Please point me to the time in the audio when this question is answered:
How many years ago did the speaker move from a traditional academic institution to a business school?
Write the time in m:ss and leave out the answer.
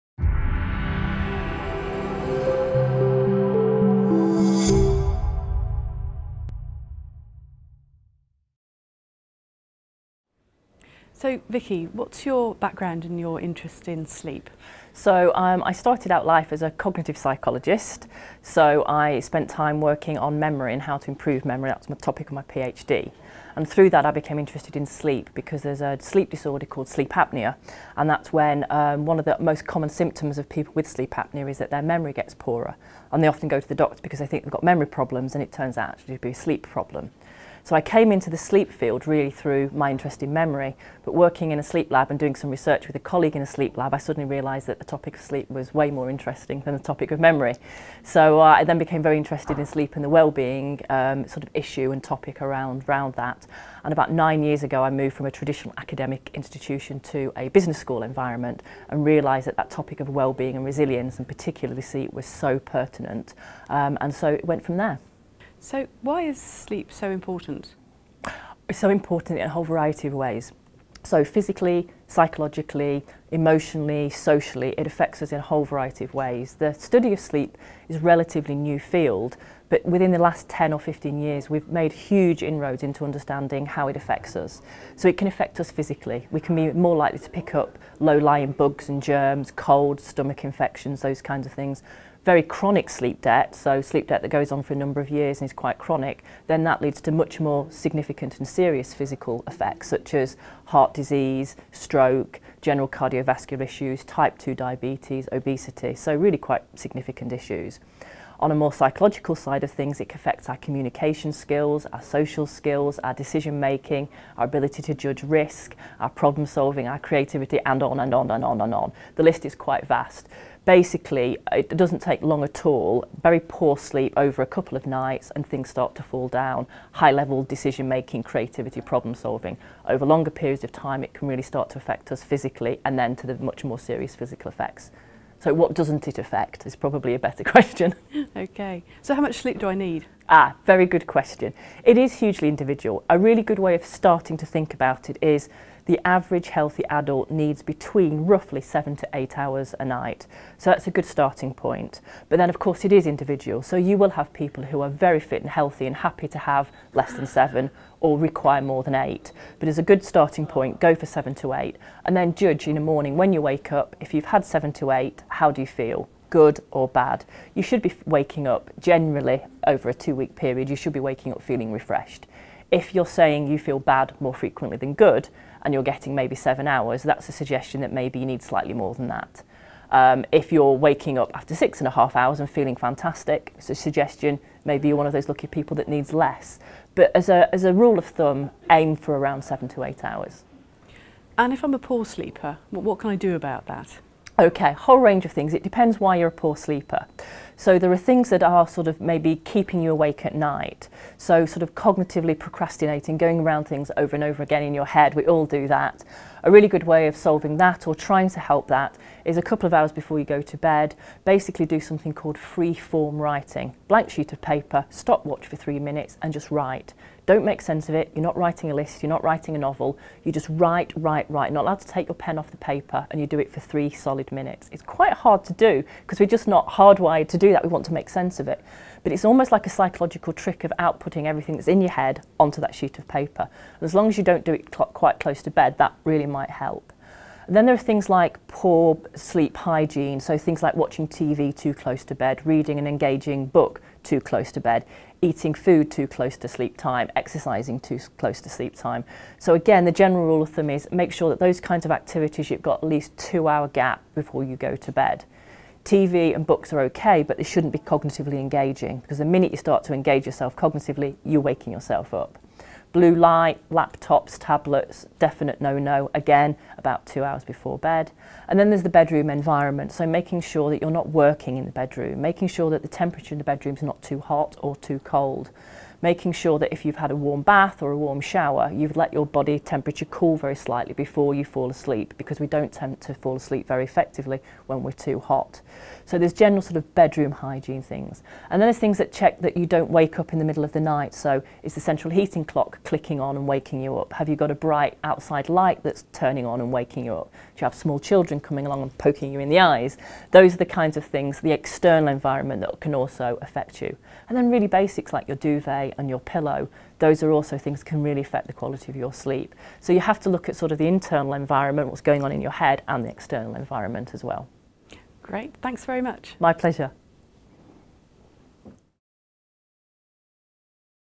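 0:54.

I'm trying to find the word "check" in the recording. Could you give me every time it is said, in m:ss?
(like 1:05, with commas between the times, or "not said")
4:49.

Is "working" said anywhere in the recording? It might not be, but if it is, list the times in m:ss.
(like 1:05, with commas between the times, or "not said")
0:19, 0:41, 4:31.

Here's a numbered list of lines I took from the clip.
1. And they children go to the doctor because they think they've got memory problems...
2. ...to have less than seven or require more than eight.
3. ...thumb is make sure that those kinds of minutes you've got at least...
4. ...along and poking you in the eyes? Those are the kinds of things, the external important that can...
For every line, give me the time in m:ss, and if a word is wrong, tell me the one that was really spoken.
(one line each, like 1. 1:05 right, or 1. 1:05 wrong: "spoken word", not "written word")
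1. 0:33 wrong: "often", not "children"
2. 2:36 right
3. 4:10 wrong: "activities", not "minutes"
4. 4:58 wrong: "environment", not "important".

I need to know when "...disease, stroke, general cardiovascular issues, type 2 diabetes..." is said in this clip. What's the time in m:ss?
1:40.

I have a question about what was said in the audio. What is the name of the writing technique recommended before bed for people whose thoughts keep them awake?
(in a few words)
free form writing.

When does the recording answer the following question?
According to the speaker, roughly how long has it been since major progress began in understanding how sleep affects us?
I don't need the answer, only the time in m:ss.
1:20.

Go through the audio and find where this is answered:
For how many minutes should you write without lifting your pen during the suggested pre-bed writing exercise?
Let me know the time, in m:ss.
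3:35.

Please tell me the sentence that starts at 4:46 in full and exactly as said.
So there's general sort of bedroom hygiene things.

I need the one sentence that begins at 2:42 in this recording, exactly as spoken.
And then judge in the morning when you wake up if you've had seven to eight, how do you feel?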